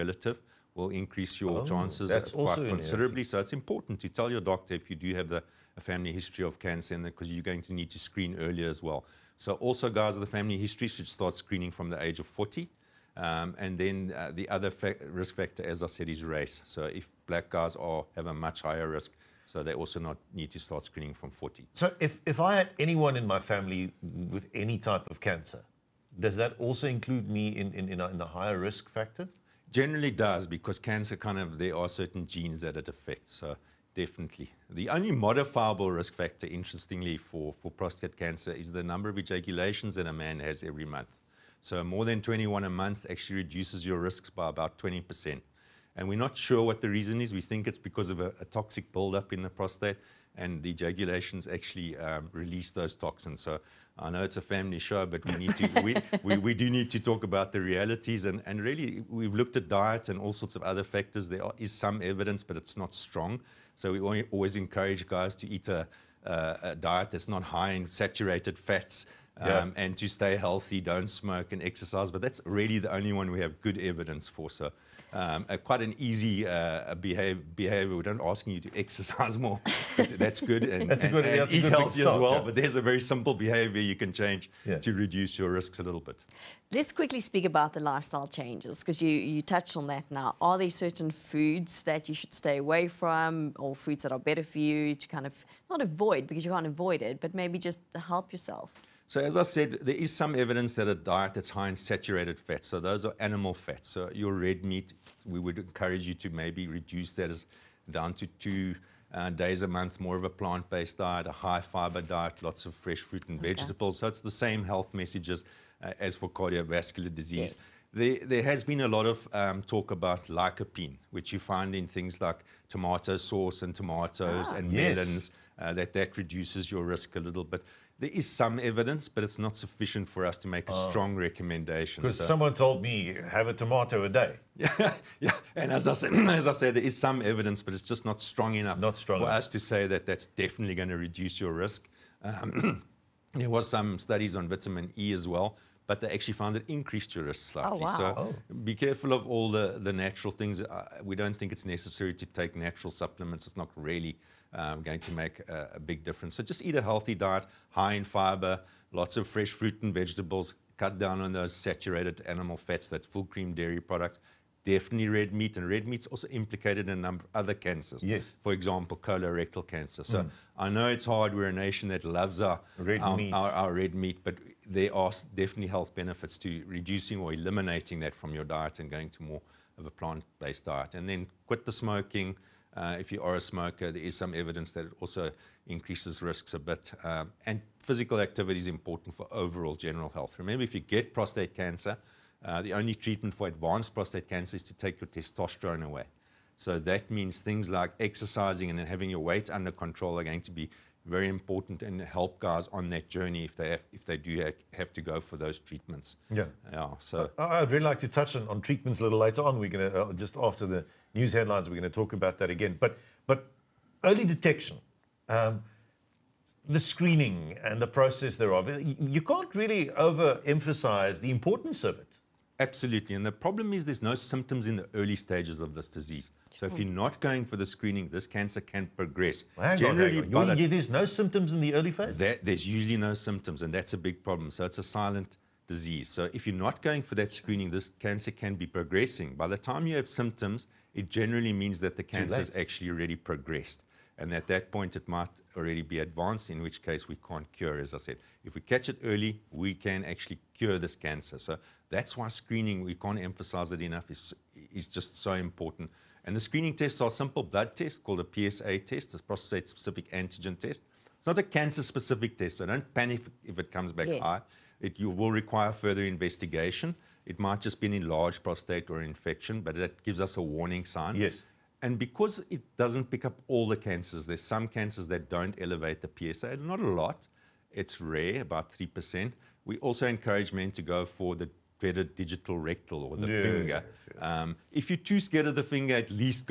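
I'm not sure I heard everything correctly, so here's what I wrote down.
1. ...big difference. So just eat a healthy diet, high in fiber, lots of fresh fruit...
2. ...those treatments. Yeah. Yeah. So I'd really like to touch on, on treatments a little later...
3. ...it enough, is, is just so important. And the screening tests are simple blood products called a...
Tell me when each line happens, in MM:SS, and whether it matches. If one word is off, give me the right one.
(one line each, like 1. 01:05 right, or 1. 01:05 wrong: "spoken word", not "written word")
1. 02:35 right
2. 03:25 right
3. 04:13 wrong: "tests", not "products".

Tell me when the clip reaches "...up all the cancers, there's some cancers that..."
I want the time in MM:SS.
04:33.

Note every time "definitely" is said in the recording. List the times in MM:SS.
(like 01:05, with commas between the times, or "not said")
00:33, 02:20, 02:44, 02:55.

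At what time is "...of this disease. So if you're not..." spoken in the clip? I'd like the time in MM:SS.
03:45.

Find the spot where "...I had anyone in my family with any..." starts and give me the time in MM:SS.
00:22.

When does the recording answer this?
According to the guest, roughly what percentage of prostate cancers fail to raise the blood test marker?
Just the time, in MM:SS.
04:38.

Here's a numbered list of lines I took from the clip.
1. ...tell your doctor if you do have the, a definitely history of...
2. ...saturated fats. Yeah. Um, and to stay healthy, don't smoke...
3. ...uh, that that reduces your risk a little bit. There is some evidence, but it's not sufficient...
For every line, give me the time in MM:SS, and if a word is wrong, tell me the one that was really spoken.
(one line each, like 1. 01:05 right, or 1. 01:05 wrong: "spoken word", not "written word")
1. 00:04 wrong: "family", not "definitely"
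2. 01:07 right
3. 02:05 right.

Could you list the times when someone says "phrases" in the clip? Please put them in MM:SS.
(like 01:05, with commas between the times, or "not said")
not said.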